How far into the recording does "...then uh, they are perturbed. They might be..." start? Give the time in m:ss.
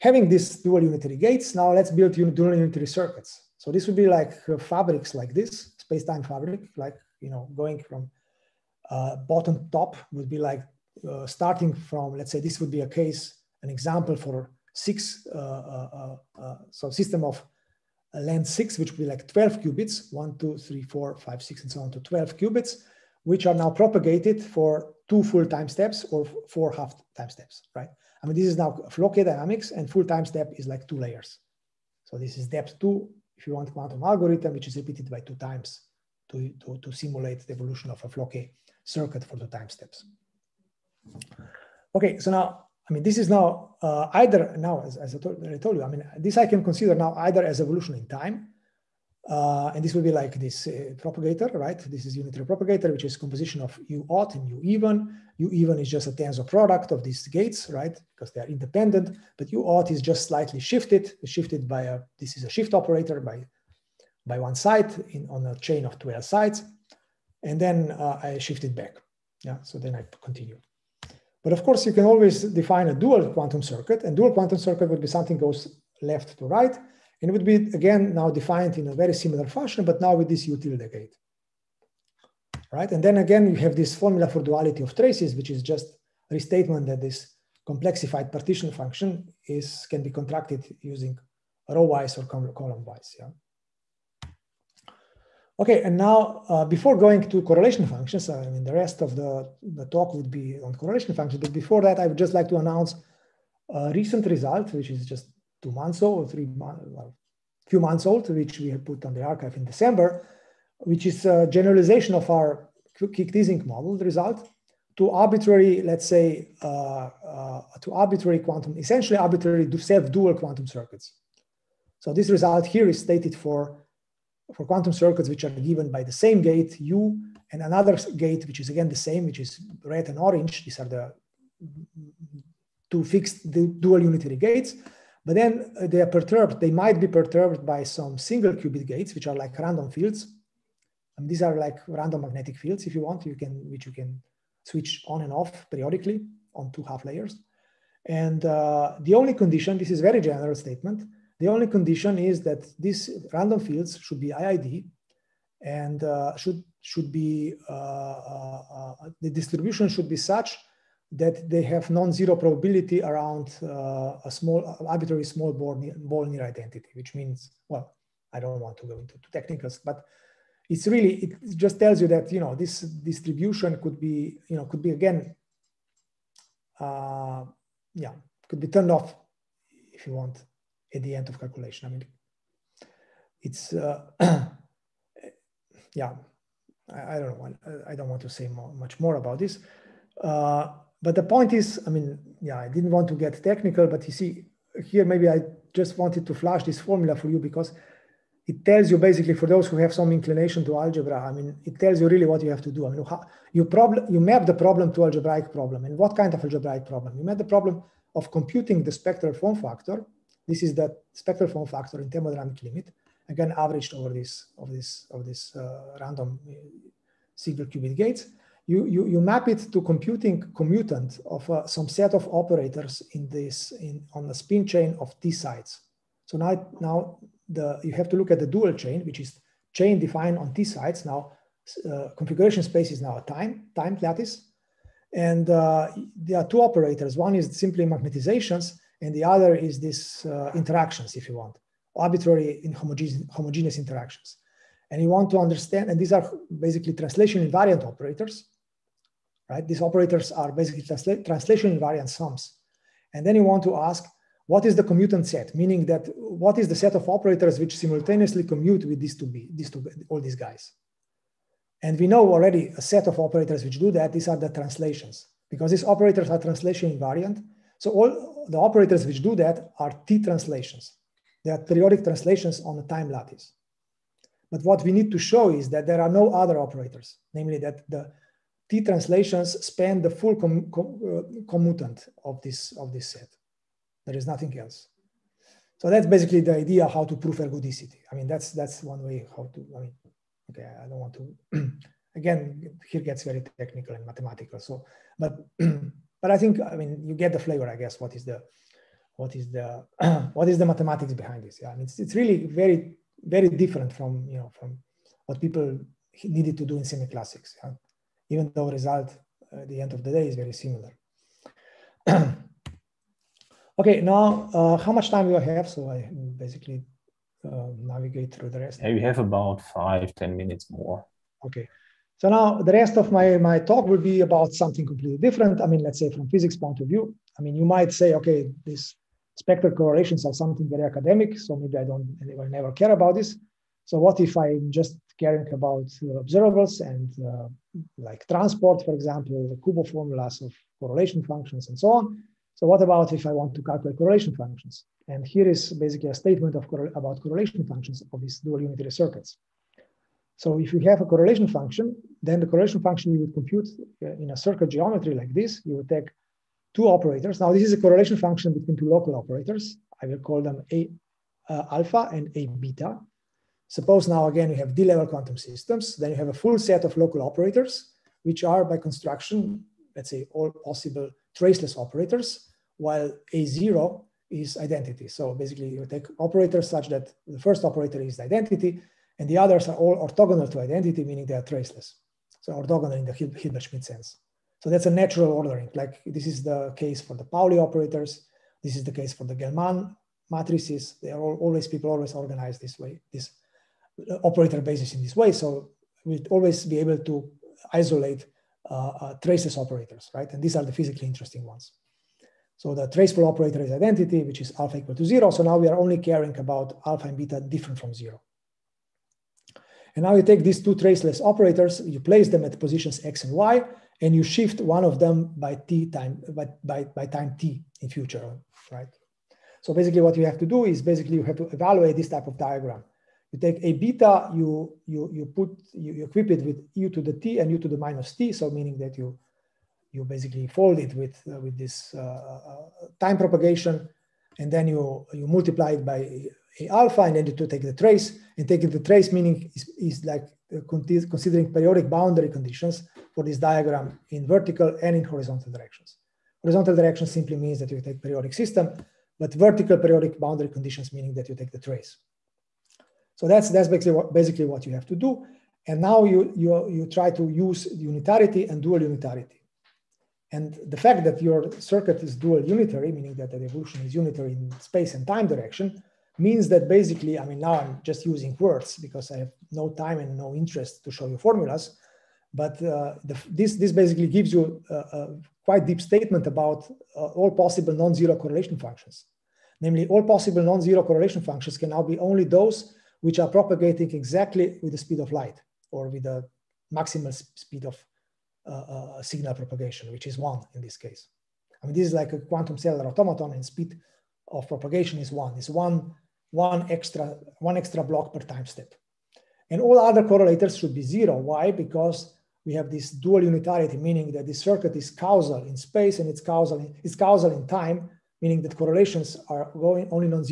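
2:15.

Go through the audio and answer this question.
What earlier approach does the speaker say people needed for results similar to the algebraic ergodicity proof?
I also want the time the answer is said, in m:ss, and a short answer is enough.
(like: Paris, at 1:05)
Semi-classics, at 5:06.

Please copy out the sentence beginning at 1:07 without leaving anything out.
And then uh, I shift it back.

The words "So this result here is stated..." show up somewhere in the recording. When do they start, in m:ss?
2:01.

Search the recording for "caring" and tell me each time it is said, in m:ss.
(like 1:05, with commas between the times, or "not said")
5:35, 6:45.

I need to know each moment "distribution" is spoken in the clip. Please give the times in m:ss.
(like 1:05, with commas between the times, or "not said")
2:39, 2:52.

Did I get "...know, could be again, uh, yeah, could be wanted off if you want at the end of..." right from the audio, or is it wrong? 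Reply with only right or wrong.
wrong.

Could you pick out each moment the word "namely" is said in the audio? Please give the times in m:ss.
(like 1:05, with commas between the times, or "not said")
4:37, 7:59.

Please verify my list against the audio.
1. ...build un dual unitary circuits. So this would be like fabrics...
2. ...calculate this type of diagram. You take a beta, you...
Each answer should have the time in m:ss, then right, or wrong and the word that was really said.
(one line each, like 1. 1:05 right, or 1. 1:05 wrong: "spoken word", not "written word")
1. 0:01 right
2. 7:01 wrong: "evaluate", not "calculate".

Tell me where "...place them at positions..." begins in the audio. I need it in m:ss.
6:51.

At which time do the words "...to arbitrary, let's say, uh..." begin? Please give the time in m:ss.
1:54.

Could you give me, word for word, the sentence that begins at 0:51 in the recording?
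This is unitary propagator, which is composition of U odd and U even.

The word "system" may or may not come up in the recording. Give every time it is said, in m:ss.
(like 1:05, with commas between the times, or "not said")
0:16, 6:05, 7:28.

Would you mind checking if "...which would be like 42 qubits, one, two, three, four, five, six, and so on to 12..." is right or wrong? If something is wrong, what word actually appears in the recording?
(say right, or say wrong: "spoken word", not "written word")
wrong: "12", not "42".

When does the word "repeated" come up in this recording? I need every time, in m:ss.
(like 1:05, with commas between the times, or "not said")
0:34.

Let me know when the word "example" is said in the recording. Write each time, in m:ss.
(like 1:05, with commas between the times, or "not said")
0:13, 5:38.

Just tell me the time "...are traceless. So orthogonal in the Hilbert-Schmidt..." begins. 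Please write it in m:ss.
6:21.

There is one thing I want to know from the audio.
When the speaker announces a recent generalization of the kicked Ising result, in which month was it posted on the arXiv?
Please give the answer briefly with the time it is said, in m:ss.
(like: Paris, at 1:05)
December, at 1:49.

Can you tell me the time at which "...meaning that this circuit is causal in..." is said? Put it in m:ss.
8:23.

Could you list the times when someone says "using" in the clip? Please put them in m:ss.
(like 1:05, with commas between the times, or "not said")
1:30, 7:48.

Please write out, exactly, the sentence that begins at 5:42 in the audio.
So what about if I want to calculate correlation functions?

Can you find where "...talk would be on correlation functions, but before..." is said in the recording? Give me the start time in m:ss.
1:39.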